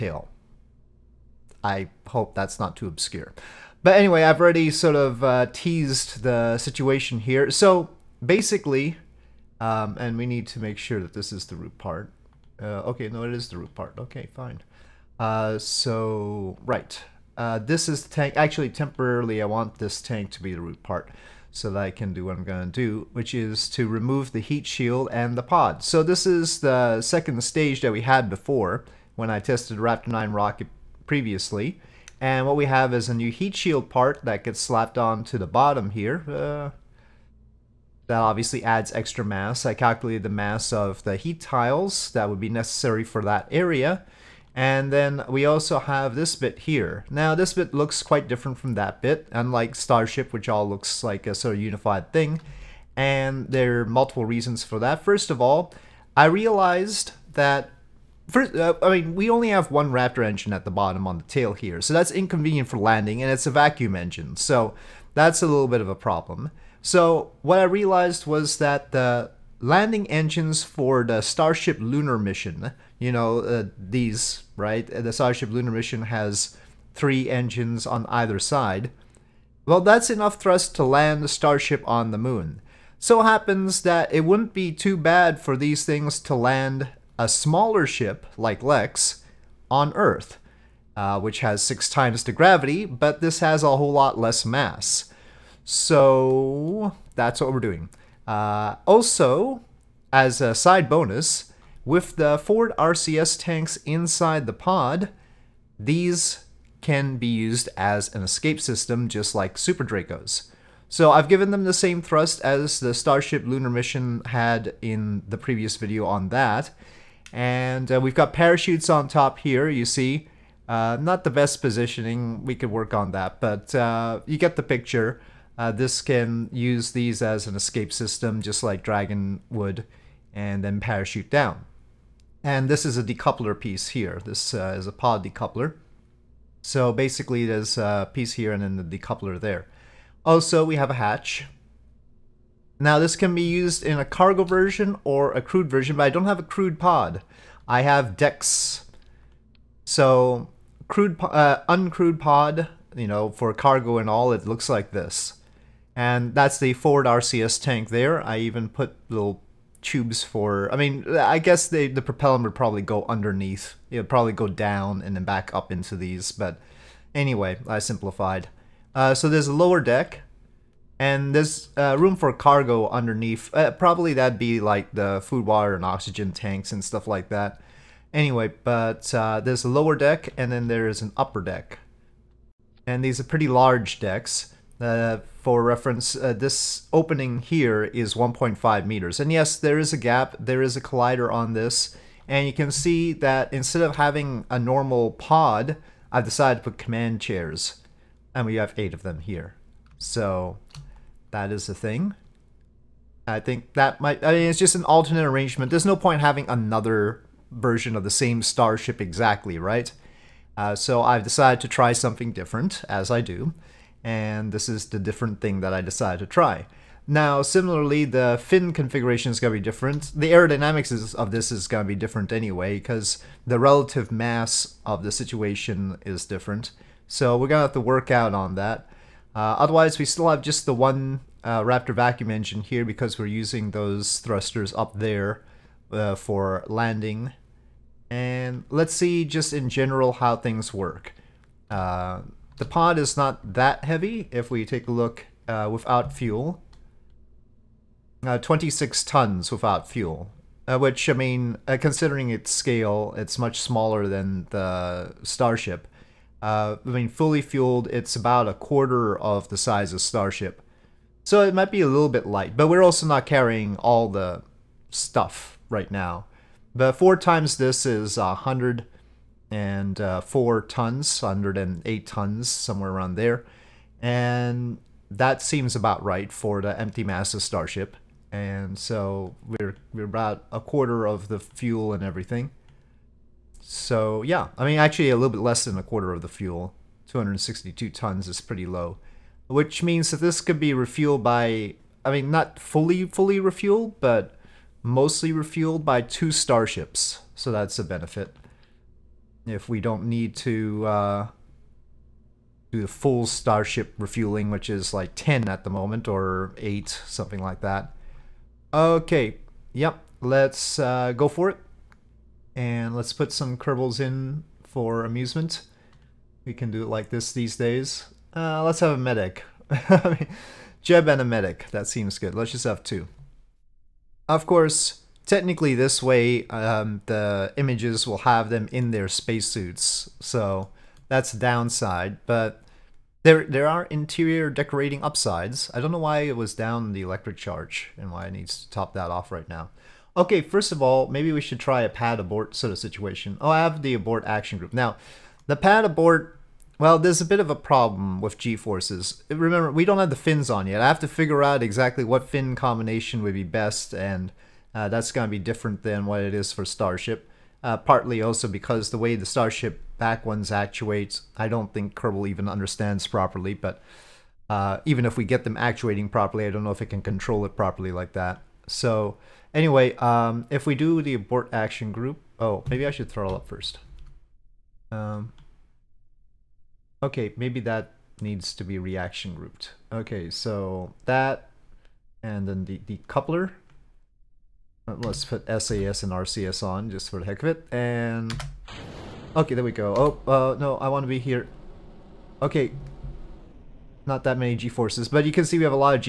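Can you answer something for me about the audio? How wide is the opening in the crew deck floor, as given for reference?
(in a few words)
1.5 meters.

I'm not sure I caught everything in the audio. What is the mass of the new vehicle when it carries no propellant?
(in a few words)
26 tons.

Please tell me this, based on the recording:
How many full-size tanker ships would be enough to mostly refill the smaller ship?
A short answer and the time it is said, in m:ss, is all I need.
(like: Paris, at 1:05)
2, at 4:56.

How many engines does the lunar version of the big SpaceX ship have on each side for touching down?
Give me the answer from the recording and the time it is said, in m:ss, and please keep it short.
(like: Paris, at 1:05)
3, at 1:16.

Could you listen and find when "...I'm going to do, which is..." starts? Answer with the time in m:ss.
0:22.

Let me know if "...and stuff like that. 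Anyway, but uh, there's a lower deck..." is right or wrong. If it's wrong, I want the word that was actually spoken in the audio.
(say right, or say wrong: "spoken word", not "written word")
right.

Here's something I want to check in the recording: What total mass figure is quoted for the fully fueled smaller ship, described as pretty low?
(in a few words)
262 tons.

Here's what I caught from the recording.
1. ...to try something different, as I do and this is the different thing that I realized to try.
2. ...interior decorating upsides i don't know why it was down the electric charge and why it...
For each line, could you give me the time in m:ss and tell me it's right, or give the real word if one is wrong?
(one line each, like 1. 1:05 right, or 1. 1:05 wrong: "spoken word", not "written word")
1. 3:31 wrong: "decided", not "realized"
2. 5:33 right.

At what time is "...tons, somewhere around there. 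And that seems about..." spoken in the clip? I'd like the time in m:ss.
4:32.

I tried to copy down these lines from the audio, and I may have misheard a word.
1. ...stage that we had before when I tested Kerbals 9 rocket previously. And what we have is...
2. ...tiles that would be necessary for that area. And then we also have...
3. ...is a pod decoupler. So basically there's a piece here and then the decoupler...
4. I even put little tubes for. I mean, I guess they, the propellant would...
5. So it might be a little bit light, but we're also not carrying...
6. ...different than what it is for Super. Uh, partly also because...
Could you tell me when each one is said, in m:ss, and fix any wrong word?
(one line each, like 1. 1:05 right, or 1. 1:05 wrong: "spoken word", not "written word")
1. 0:27 wrong: "Raptor", not "Kerbals"
2. 0:41 right
3. 2:14 right
4. 2:38 right
5. 4:21 right
6. 5:55 wrong: "Starship", not "Super".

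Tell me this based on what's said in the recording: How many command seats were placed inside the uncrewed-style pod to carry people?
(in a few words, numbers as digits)
8.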